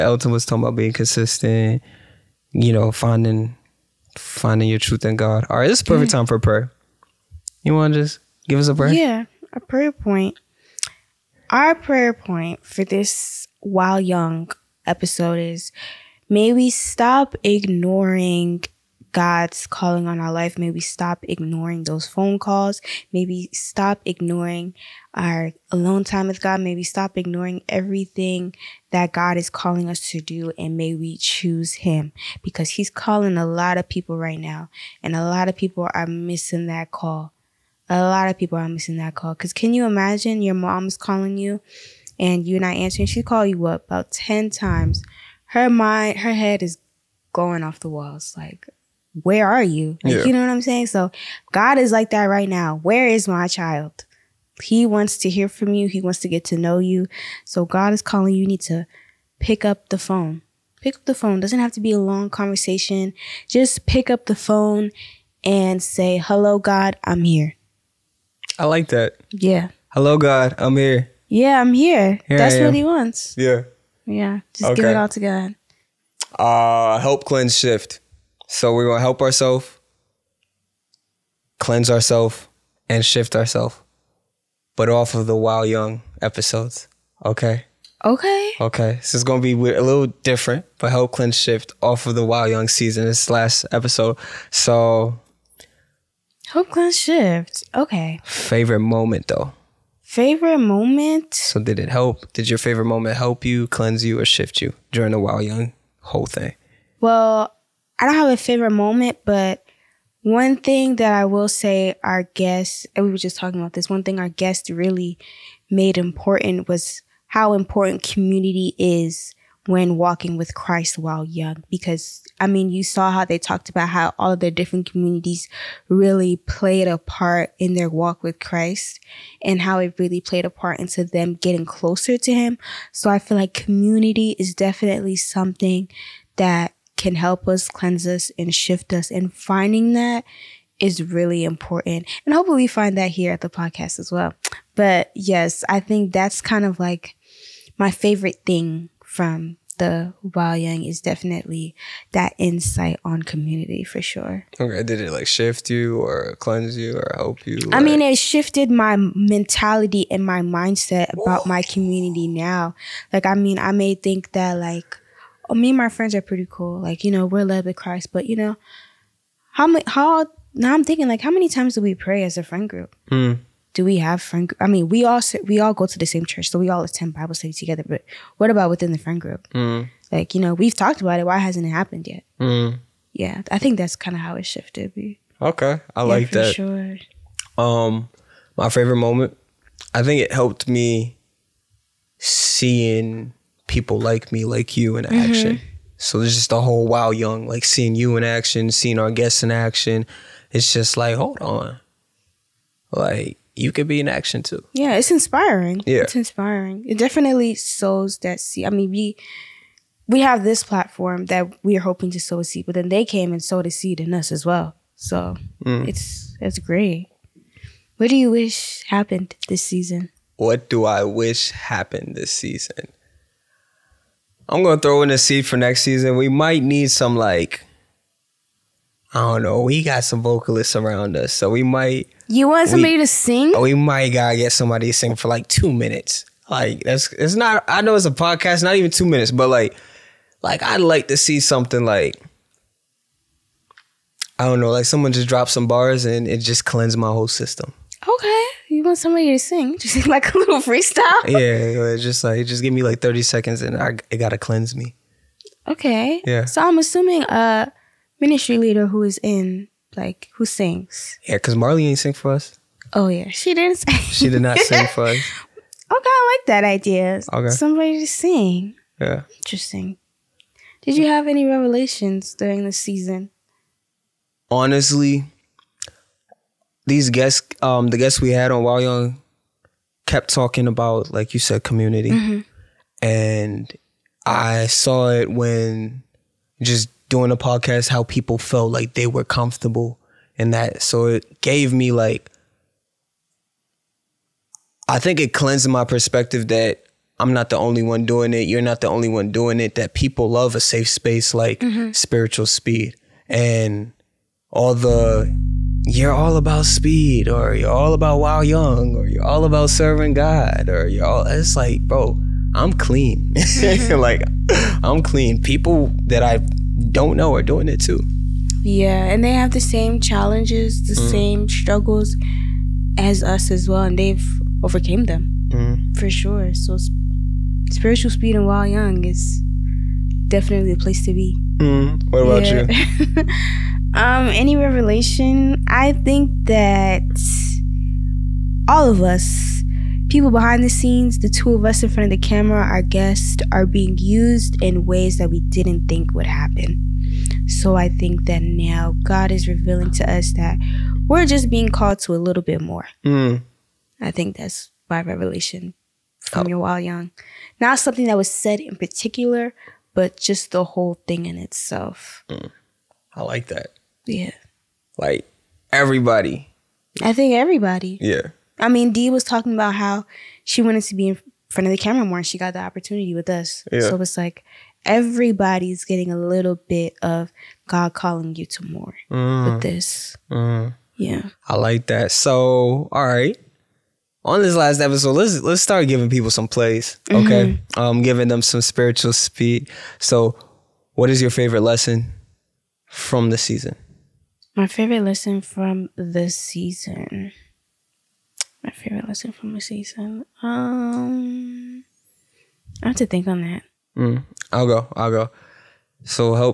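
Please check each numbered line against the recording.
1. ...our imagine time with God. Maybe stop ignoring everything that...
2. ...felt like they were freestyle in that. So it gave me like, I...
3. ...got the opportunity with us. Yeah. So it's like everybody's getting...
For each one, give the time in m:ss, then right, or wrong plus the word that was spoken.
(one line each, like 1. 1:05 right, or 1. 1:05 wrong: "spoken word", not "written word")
1. 0:25 wrong: "alone", not "imagine"
2. 4:48 wrong: "comfortable", not "freestyle"
3. 6:12 right.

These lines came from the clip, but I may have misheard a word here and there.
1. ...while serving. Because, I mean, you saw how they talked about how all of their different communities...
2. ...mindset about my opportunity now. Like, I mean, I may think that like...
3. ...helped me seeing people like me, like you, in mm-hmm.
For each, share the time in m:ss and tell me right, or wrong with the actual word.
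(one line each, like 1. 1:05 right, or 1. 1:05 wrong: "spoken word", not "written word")
1. 2:00 wrong: "young", not "serving"
2. 2:40 wrong: "community", not "opportunity"
3. 3:10 right.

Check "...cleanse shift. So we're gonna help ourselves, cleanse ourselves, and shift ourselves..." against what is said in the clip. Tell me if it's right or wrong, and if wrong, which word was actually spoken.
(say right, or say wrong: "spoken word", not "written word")
right.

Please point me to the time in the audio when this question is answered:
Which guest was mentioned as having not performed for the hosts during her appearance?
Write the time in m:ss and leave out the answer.
4:21.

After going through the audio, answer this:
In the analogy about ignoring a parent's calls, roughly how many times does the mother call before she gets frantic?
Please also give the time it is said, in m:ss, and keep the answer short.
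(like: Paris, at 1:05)
10, at 0:43.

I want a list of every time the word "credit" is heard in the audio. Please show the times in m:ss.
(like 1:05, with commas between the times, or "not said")
not said.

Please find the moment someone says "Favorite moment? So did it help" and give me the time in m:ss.
1:40.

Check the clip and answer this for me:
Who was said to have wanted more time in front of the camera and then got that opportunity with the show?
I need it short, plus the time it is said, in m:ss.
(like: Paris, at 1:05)
Dee, at 6:08.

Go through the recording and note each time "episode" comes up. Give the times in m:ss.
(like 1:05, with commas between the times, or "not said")
0:14, 1:26, 1:33, 6:24.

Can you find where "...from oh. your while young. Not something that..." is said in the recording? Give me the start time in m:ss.
5:56.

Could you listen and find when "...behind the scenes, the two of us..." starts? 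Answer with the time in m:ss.
5:40.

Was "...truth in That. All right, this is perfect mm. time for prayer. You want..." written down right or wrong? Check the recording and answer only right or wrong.
wrong.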